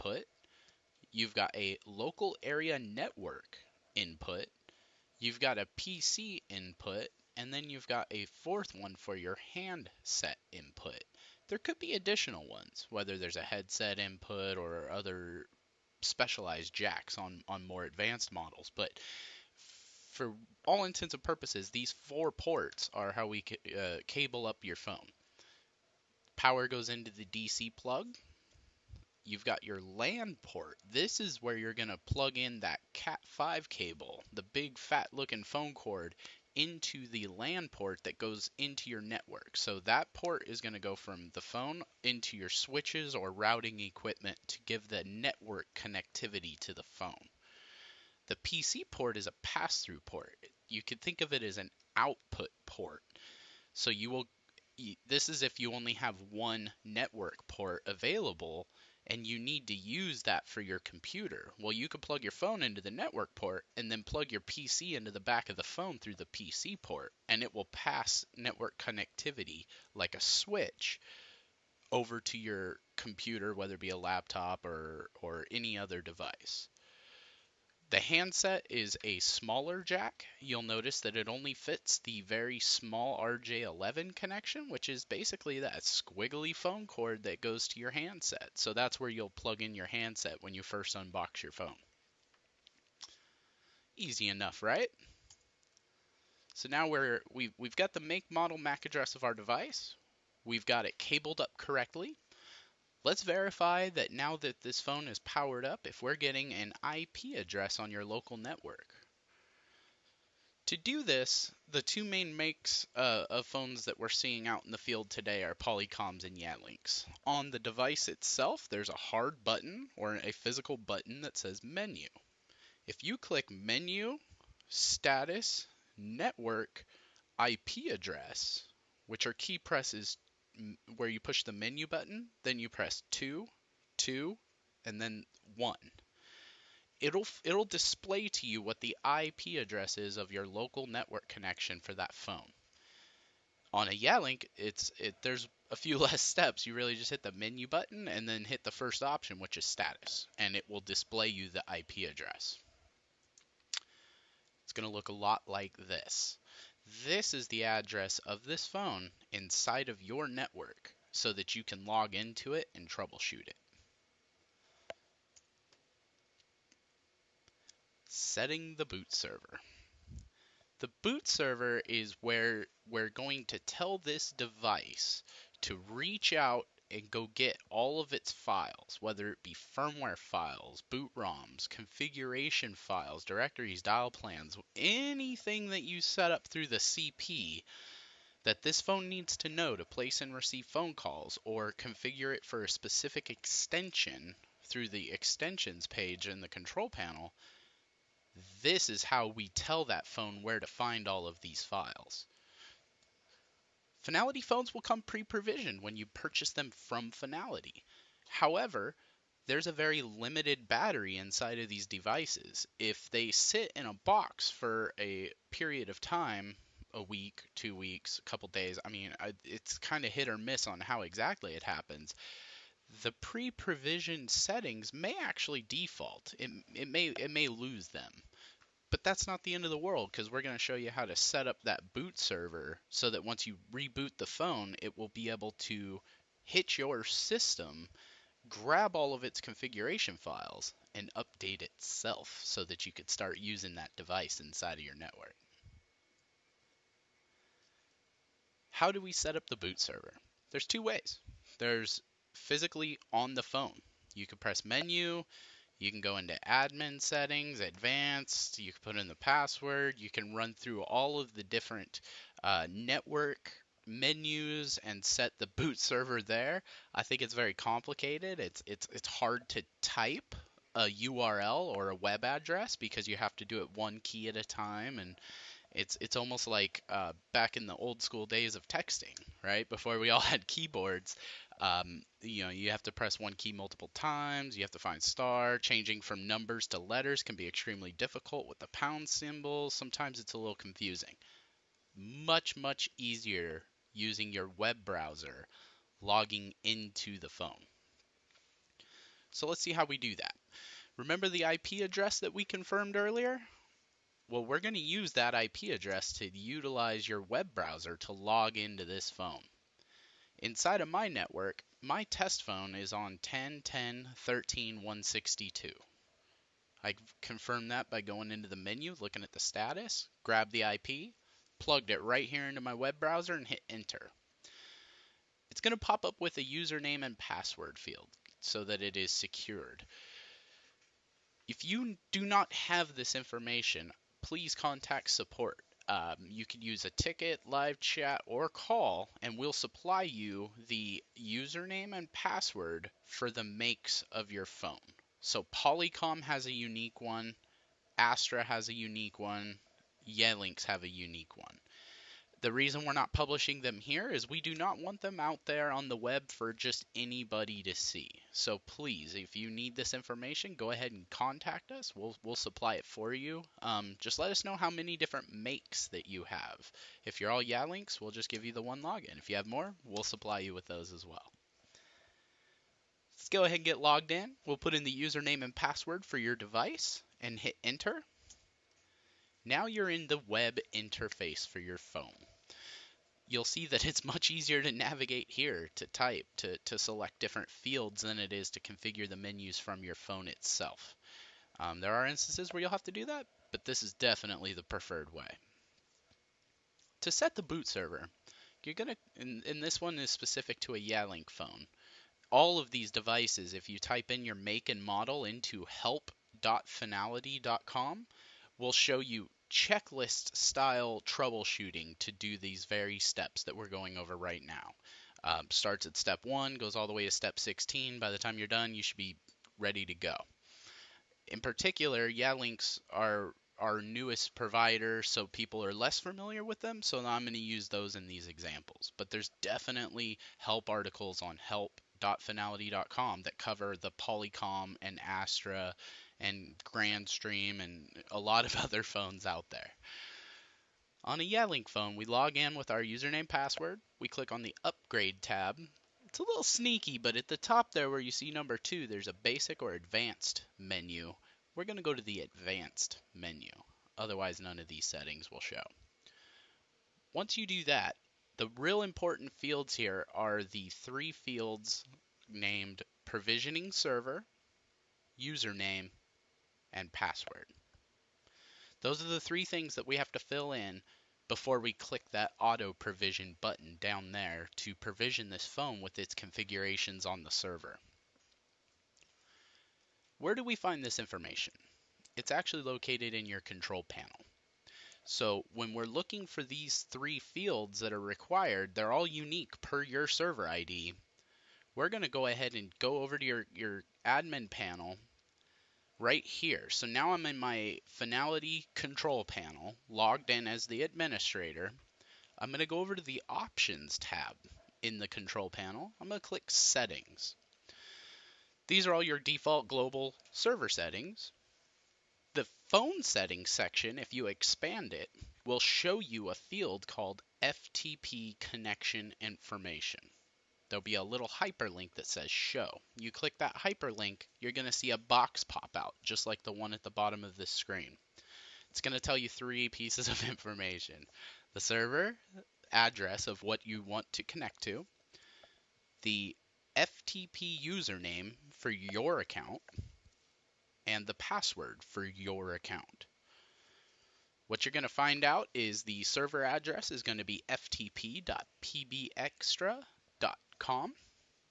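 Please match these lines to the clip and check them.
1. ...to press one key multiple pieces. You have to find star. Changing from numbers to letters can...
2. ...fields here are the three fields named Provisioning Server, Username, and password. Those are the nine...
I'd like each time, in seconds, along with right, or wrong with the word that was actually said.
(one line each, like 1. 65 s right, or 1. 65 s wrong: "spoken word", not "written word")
1. 282 s wrong: "times", not "pieces"
2. 459 s wrong: "three", not "nine".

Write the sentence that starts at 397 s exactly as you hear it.
To set the boot server, you're gonna, and, and this one is specific to a Yealink phone.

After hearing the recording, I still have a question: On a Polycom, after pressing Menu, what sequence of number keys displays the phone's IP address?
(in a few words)
2, 2, and then 1.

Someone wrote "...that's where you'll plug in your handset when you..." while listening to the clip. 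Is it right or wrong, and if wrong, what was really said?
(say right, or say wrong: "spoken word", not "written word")
right.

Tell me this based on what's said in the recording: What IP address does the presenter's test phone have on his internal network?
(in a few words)
10.10.13.162.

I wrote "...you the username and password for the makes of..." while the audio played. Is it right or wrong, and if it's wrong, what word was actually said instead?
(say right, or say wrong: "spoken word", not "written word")
right.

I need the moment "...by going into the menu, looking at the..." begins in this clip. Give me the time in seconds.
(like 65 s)
317 s.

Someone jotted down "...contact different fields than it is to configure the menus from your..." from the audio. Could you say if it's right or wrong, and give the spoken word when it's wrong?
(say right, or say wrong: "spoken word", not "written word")
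wrong: "select", not "contact".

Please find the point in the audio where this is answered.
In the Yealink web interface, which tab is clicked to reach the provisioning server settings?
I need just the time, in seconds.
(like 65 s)
444 s.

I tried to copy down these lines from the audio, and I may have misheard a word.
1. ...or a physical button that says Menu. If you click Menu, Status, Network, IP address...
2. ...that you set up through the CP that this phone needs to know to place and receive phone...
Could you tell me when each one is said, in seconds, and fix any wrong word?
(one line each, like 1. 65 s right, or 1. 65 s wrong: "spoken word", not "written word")
1. 119 s right
2. 185 s right.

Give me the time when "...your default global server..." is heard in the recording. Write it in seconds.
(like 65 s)
509 s.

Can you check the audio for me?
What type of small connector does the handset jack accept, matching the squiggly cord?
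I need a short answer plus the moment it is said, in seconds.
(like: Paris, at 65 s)
RJ11, at 83 s.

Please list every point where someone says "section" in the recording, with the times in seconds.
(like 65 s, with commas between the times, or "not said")
513 s.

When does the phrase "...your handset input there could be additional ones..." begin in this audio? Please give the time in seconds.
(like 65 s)
9 s.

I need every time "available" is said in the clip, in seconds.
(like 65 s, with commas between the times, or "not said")
57 s.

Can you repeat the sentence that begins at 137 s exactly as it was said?
It'll it'll display to you what the IP address is of your local network connection for that phone.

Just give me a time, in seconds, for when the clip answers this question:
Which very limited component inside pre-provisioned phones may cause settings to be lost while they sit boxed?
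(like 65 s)
210 s.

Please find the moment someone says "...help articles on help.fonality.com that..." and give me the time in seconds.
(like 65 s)
430 s.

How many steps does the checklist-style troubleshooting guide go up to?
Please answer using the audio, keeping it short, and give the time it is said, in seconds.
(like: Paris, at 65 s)
16, at 417 s.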